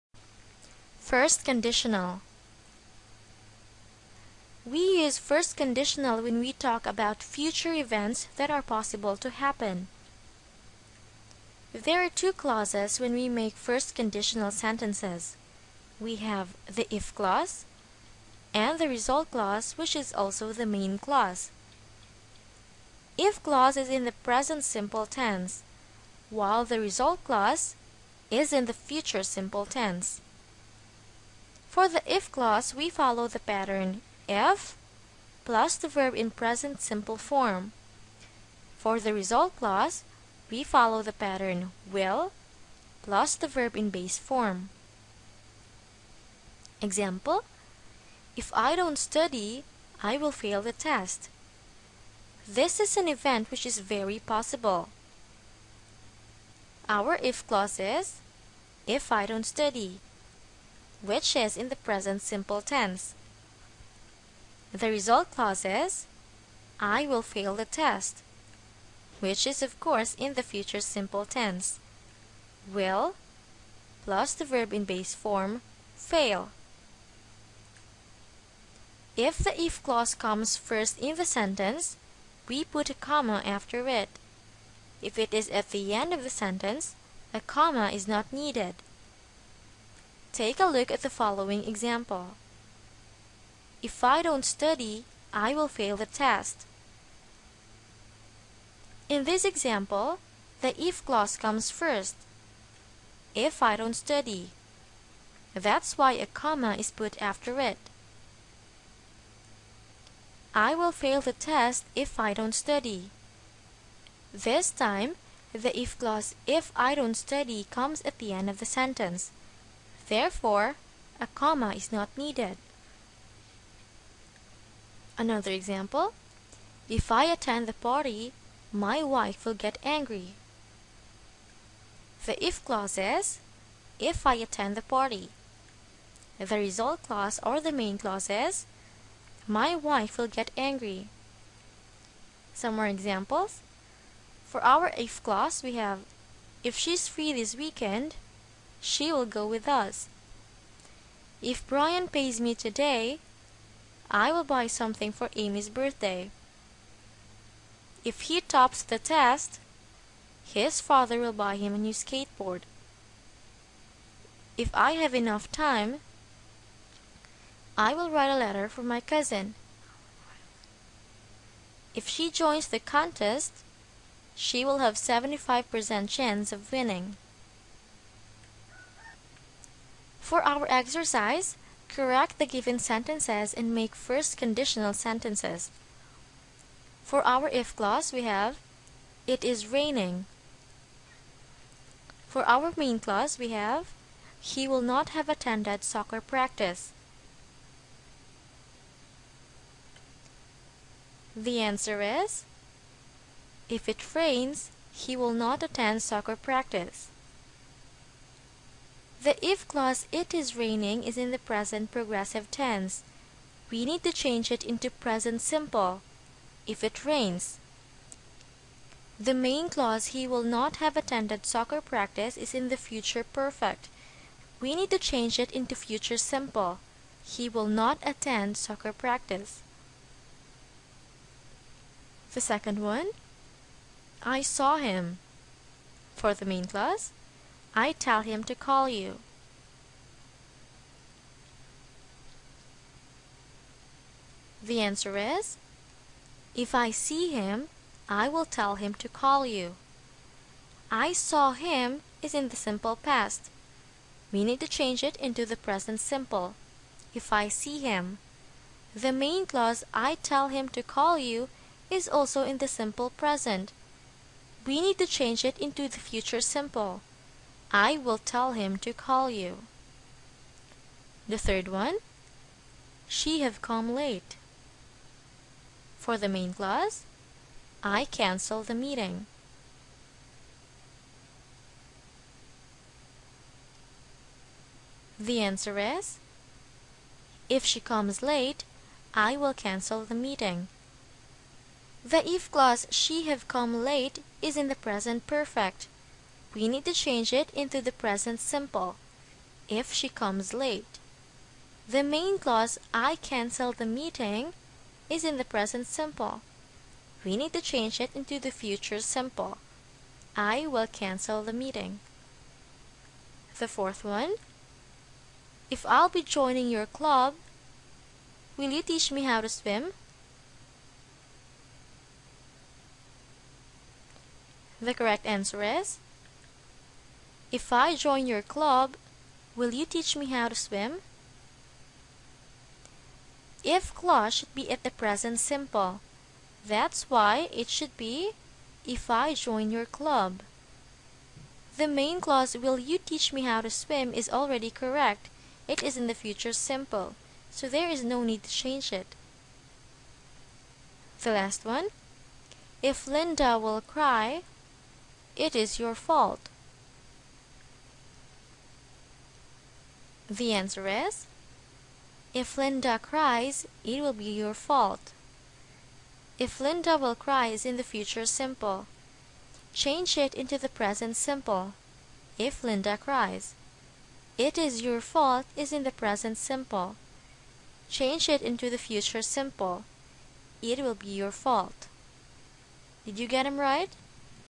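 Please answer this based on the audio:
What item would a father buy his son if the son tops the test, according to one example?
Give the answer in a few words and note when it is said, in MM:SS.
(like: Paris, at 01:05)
a new skateboard, at 02:41.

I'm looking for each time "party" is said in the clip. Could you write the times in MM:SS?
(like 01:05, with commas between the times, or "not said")
02:07, 02:14.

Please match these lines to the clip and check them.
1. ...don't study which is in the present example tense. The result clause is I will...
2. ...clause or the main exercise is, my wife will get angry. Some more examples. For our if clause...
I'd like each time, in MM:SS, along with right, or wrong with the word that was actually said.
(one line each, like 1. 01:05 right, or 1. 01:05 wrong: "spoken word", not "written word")
1. 00:59 wrong: "simple", not "example"
2. 02:17 wrong: "clause", not "exercise".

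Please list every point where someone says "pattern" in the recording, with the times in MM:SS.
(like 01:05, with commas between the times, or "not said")
00:33, 00:41.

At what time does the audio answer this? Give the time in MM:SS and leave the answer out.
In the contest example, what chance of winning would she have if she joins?
02:54.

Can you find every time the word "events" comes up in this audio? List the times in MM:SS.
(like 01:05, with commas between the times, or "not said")
00:07, 00:53.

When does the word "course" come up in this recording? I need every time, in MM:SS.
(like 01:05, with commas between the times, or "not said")
01:09.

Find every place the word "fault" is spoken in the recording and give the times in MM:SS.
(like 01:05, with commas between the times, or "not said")
05:55, 06:04, 06:15, 06:21.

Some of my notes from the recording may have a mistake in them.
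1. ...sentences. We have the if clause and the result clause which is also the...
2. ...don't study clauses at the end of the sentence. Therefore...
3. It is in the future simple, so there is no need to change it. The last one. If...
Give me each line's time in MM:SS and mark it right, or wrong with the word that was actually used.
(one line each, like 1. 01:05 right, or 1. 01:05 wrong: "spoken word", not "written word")
1. 00:14 right
2. 01:56 wrong: "comes", not "clauses"
3. 05:45 right.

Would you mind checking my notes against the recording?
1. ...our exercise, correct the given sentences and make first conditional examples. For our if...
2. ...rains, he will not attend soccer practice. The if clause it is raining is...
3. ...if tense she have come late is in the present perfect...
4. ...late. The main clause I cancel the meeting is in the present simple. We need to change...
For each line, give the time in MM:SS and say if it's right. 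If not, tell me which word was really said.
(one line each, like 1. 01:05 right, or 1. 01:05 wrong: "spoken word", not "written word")
1. 03:00 wrong: "sentences", not "examples"
2. 03:24 right
3. 04:52 wrong: "clause", not "tense"
4. 05:00 right.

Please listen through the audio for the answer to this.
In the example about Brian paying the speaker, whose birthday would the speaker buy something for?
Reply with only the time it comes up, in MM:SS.
02:35.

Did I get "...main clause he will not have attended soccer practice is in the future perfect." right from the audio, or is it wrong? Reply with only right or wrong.
right.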